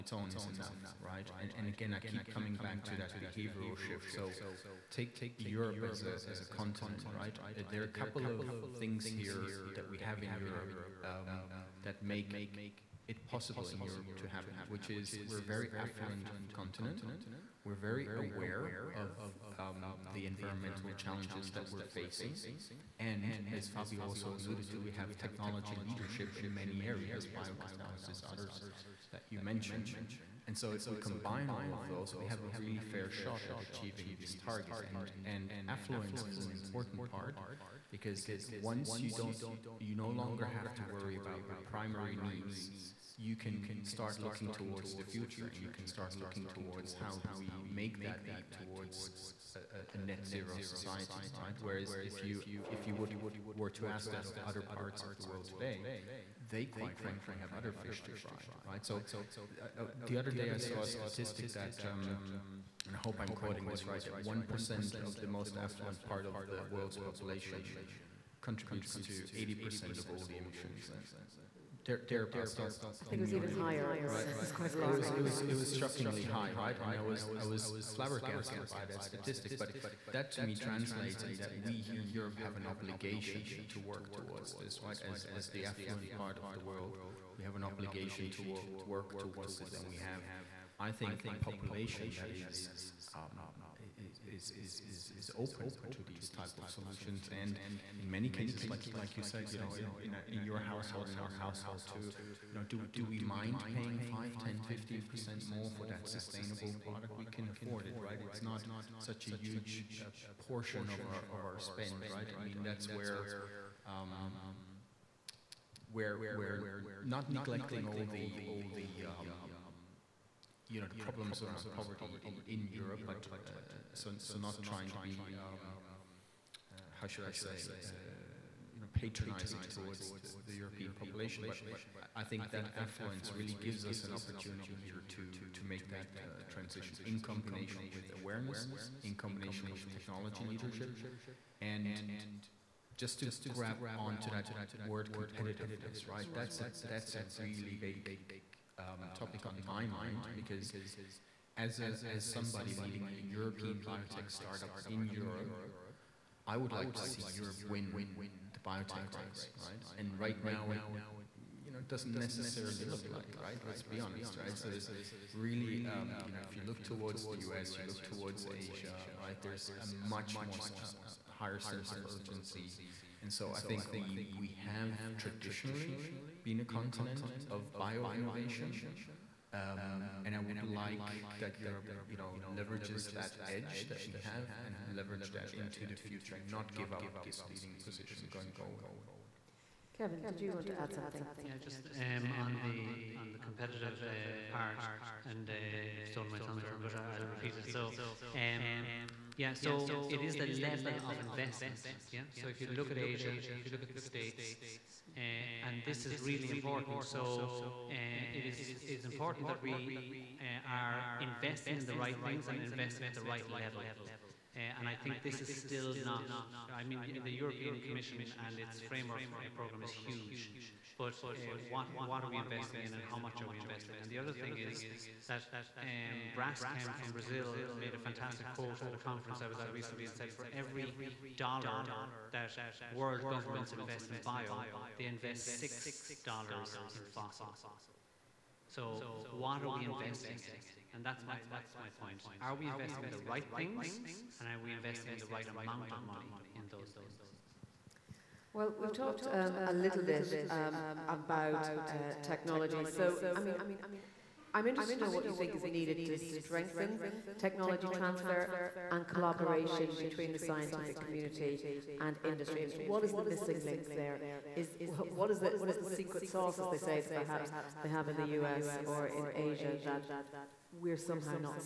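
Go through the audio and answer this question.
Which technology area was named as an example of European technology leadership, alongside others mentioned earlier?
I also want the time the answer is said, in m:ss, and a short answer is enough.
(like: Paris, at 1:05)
biocatalysis, at 0:27.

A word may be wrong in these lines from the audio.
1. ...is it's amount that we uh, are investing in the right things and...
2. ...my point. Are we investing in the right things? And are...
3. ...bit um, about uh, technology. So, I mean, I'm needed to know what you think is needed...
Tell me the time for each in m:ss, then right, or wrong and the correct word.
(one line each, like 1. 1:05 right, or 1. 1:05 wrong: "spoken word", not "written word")
1. 3:28 wrong: "important", not "amount"
2. 4:01 right
3. 4:10 wrong: "interested", not "needed".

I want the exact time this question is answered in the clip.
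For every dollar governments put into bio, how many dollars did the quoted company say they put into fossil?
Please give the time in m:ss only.
3:55.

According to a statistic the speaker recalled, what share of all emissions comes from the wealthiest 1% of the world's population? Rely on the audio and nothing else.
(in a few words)
80%.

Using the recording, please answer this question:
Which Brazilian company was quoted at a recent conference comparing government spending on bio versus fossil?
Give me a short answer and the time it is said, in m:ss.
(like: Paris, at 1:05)
Braskem, at 3:46.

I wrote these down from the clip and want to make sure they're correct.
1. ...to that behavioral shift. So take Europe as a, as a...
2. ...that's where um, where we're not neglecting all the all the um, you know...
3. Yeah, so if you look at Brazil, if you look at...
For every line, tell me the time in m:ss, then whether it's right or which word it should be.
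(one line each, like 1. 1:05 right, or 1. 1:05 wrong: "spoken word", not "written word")
1. 0:02 right
2. 1:52 right
3. 3:22 wrong: "Asia", not "Brazil".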